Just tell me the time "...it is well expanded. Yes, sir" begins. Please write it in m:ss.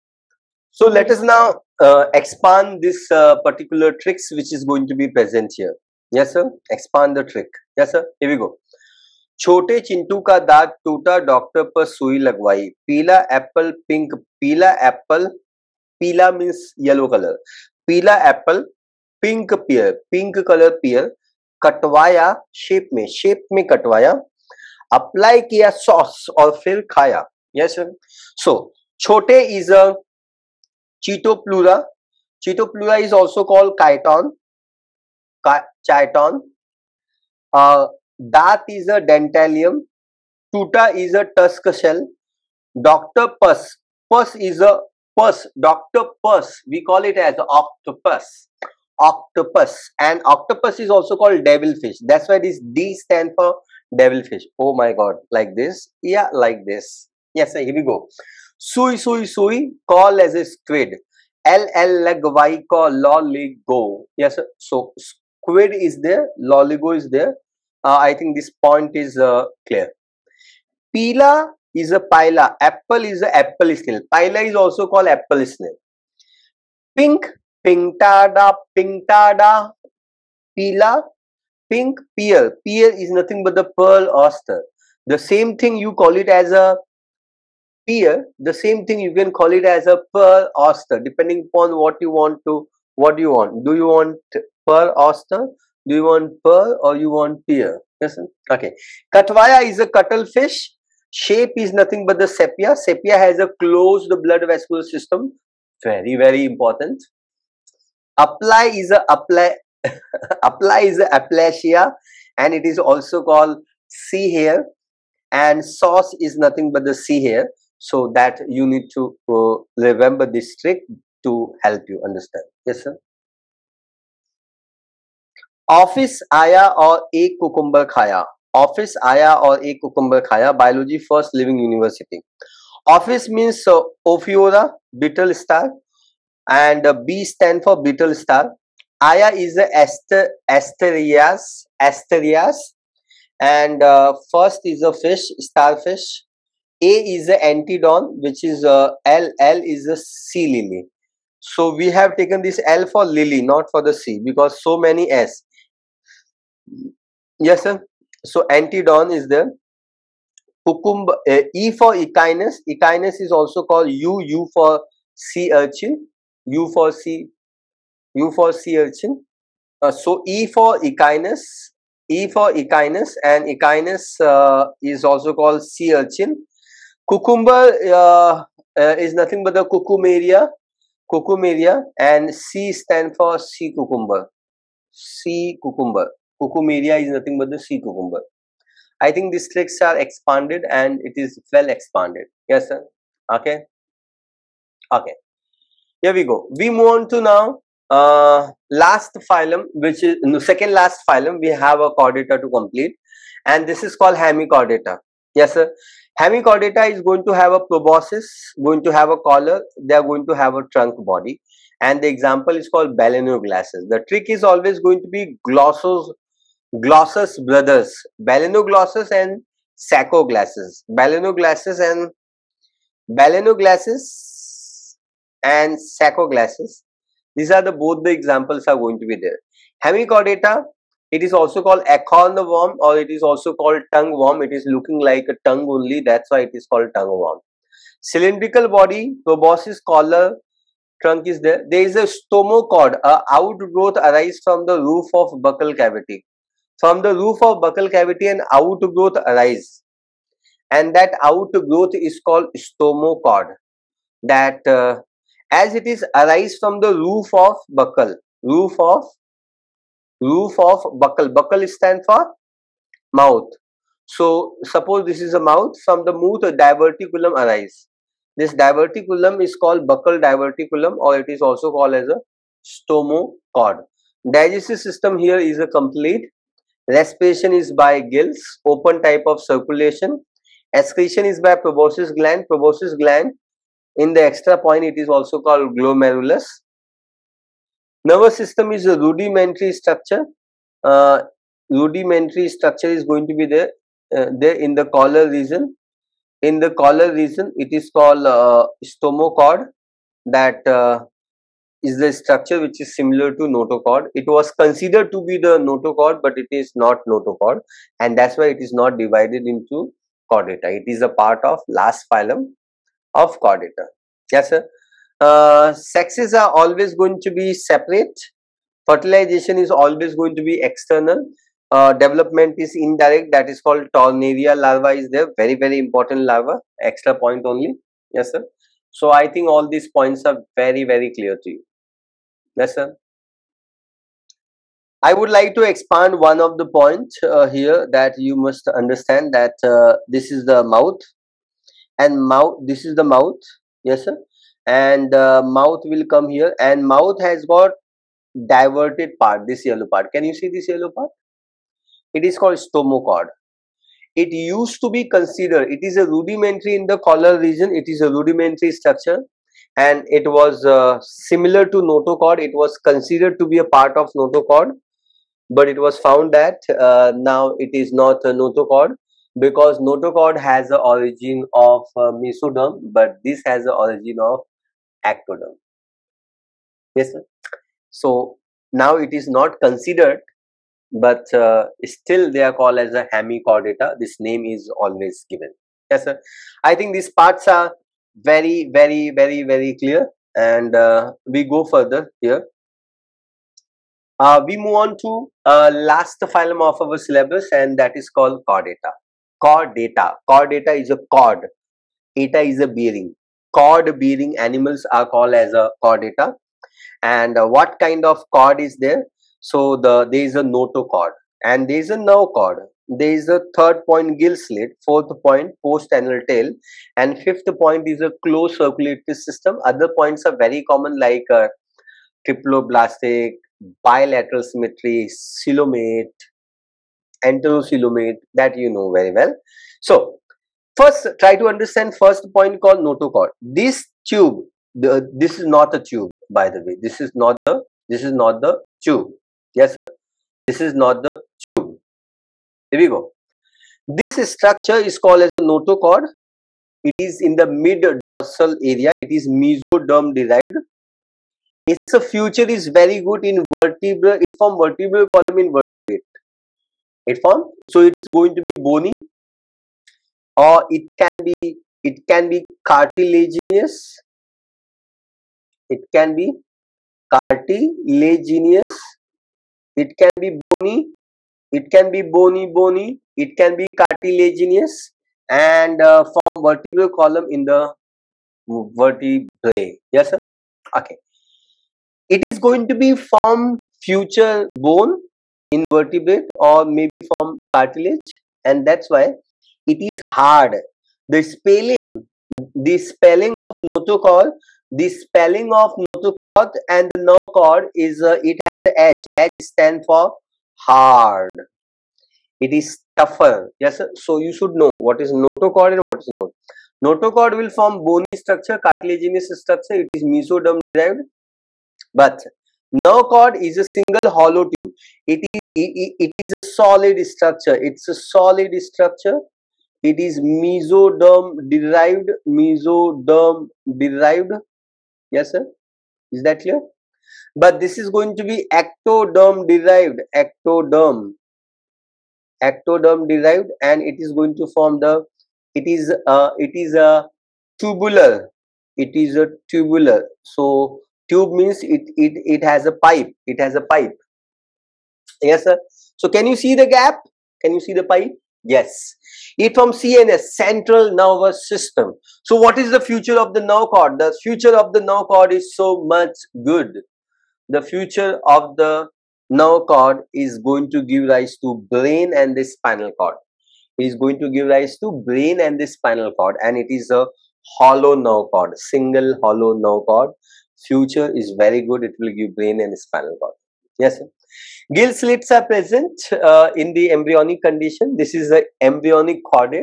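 3:11.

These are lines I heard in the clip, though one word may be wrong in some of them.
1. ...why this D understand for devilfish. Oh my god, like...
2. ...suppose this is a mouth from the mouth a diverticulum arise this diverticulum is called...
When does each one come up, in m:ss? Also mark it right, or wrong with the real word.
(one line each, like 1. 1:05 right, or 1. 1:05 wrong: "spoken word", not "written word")
1. 0:52 wrong: "stand", not "understand"
2. 4:24 right.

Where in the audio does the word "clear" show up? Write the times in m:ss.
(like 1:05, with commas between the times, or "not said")
1:09, 5:31, 6:29, 8:46.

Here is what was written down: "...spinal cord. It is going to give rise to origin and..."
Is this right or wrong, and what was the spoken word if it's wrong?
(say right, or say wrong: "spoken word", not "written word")
wrong: "brain", not "origin".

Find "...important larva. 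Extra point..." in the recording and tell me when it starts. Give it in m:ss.
5:25.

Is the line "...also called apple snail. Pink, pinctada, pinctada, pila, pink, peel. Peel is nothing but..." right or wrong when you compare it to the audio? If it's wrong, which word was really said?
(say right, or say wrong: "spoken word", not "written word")
right.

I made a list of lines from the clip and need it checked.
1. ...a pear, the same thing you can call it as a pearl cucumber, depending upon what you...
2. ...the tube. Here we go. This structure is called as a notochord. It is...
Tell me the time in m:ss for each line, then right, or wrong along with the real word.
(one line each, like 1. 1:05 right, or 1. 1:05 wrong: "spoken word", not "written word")
1. 1:26 wrong: "oyster", not "cucumber"
2. 7:21 right.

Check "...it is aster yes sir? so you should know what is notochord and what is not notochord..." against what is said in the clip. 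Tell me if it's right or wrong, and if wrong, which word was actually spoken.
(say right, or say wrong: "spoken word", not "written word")
wrong: "tougher", not "aster".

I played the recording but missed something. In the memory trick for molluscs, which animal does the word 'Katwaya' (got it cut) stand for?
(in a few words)
Cuttlefish.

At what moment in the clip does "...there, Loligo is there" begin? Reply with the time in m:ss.
1:06.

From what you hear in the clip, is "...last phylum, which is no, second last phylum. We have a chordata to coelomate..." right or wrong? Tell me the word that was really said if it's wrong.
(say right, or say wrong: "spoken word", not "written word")
wrong: "complete", not "coelomate".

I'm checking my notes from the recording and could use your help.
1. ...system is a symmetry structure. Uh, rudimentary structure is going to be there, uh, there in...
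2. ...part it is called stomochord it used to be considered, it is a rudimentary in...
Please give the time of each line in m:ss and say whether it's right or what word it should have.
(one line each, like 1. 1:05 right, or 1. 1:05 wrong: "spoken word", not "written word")
1. 4:48 wrong: "rudimentary", not "symmetry"
2. 5:50 right.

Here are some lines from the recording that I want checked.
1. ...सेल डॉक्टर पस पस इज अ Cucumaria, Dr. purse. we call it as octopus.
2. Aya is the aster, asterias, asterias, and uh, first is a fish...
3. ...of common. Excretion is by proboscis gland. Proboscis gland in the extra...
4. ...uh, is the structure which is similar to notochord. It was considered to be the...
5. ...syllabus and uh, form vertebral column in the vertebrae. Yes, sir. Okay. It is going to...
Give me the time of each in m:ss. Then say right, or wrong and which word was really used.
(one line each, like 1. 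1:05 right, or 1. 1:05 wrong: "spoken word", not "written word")
1. 0:41 wrong: "Purse", not "Cucumaria"
2. 2:19 right
3. 4:39 wrong: "circulation", not "common"
4. 5:00 right
5. 7:53 wrong: "cartilaginous", not "syllabus".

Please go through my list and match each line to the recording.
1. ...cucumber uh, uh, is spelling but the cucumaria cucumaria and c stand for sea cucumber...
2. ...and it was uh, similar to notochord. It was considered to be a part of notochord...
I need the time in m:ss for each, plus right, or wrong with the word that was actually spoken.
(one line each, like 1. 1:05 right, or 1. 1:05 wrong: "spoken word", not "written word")
1. 2:57 wrong: "nothing", not "spelling"
2. 5:59 right.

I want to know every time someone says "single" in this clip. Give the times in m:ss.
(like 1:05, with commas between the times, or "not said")
8:33, 9:28.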